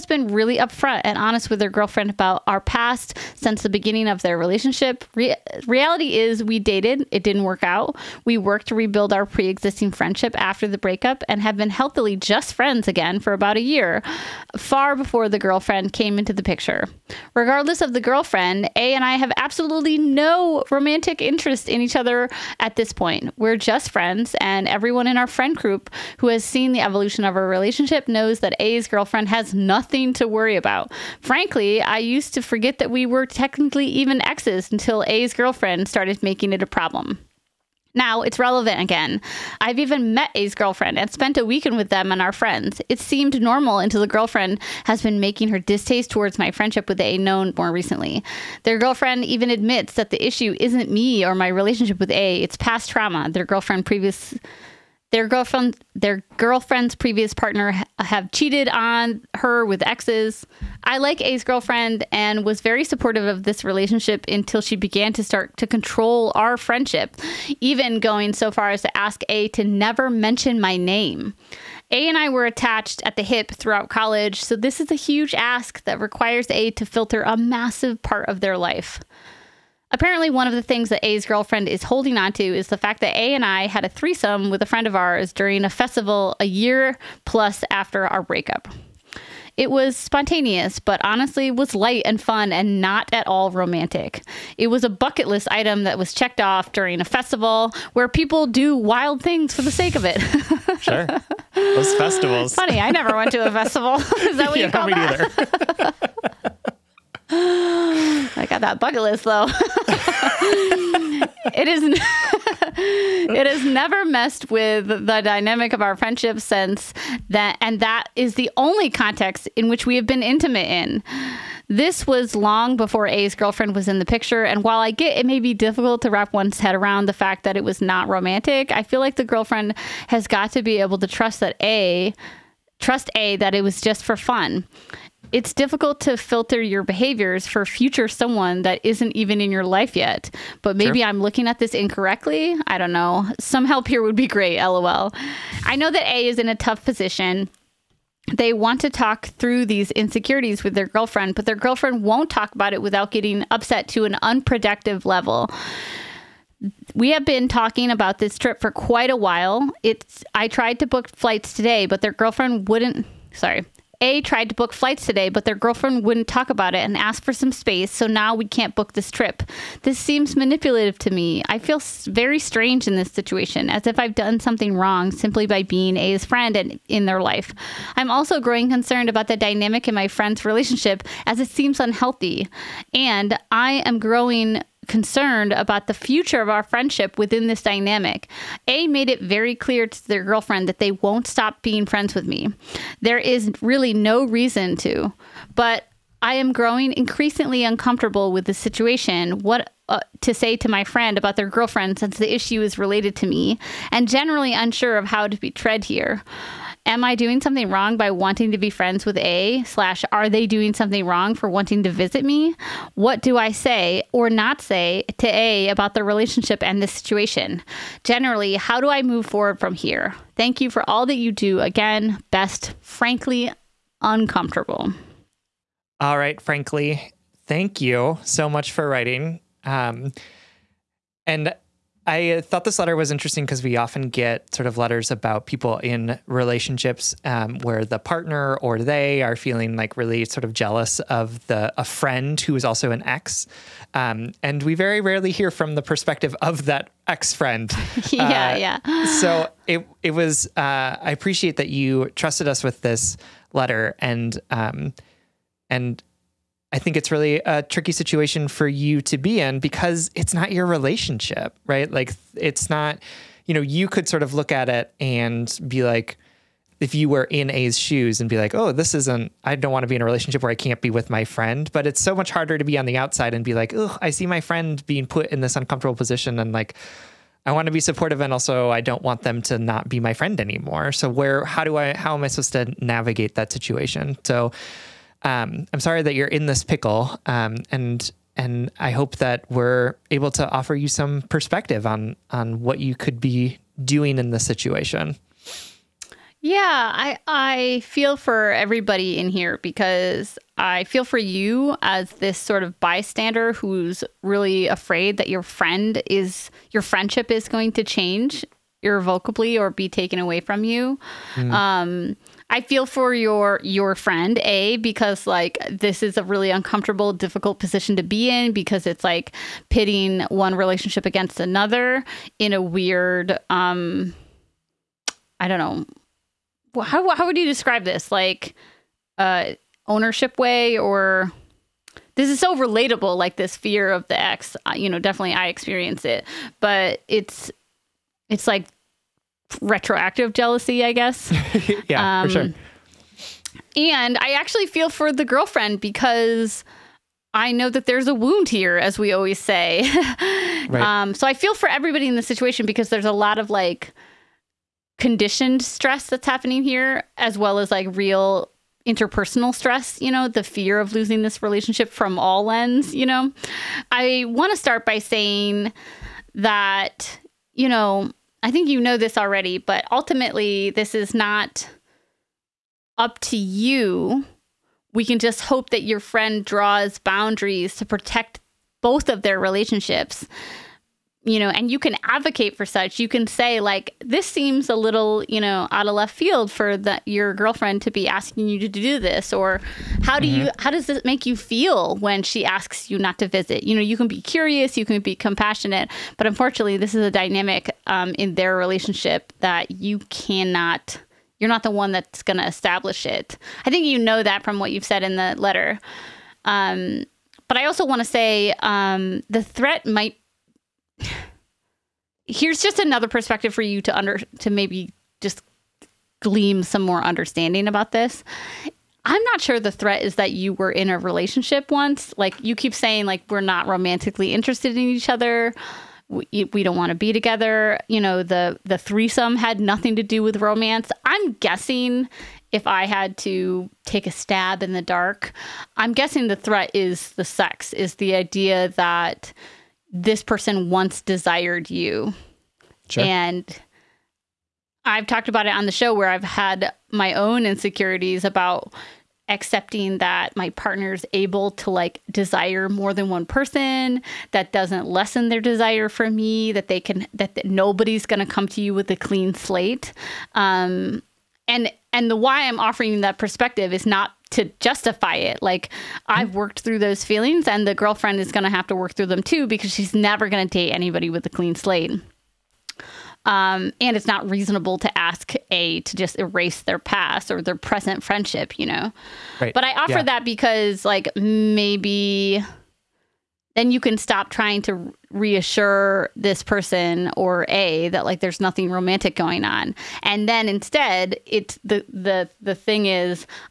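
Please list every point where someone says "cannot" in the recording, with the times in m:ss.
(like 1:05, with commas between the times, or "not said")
6:40.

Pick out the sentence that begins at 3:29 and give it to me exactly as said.
Slash, are they doing something wrong for wanting to visit me?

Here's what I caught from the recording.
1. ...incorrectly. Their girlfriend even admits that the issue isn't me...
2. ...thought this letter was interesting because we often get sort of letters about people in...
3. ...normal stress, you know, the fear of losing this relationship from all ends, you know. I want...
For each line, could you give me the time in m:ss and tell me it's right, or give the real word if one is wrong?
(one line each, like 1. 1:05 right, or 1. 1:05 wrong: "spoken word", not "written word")
1. 0:47 wrong: "recently", not "incorrectly"
2. 3:52 right
3. 5:58 wrong: "interpersonal", not "normal".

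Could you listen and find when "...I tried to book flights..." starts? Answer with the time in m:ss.
2:40.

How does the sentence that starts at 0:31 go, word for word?
Frankly, I used to forget that we were technically even exes until A's girlfriend started making it a problem.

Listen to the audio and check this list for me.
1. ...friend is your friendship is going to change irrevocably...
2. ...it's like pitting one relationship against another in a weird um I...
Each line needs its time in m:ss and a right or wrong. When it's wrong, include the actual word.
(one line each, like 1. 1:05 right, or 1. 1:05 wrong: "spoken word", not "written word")
1. 5:05 right
2. 5:18 right.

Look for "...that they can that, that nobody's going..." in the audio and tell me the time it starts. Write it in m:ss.
7:36.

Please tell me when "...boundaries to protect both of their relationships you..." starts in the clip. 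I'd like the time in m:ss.
6:16.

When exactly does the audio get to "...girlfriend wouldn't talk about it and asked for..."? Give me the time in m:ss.
2:45.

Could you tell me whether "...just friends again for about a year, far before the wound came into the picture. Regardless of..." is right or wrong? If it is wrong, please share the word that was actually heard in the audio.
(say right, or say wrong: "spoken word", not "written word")
wrong: "girlfriend", not "wound".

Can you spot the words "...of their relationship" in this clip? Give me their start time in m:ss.
0:04.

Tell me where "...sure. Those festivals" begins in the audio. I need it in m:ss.
1:40.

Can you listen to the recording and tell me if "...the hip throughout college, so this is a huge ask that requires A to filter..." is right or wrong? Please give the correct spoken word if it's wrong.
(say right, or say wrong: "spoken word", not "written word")
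right.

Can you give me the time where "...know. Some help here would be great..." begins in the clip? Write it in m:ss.
2:22.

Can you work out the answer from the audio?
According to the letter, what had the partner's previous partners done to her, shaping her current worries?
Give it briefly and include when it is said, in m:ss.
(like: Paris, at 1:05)
cheated on her, at 0:58.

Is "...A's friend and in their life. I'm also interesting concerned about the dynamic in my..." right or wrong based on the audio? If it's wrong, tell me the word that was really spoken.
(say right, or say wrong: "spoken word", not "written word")
wrong: "growing", not "interesting".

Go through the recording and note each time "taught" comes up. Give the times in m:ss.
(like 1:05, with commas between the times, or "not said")
not said.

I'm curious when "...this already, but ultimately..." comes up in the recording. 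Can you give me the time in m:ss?
6:08.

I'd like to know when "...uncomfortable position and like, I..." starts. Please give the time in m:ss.
4:35.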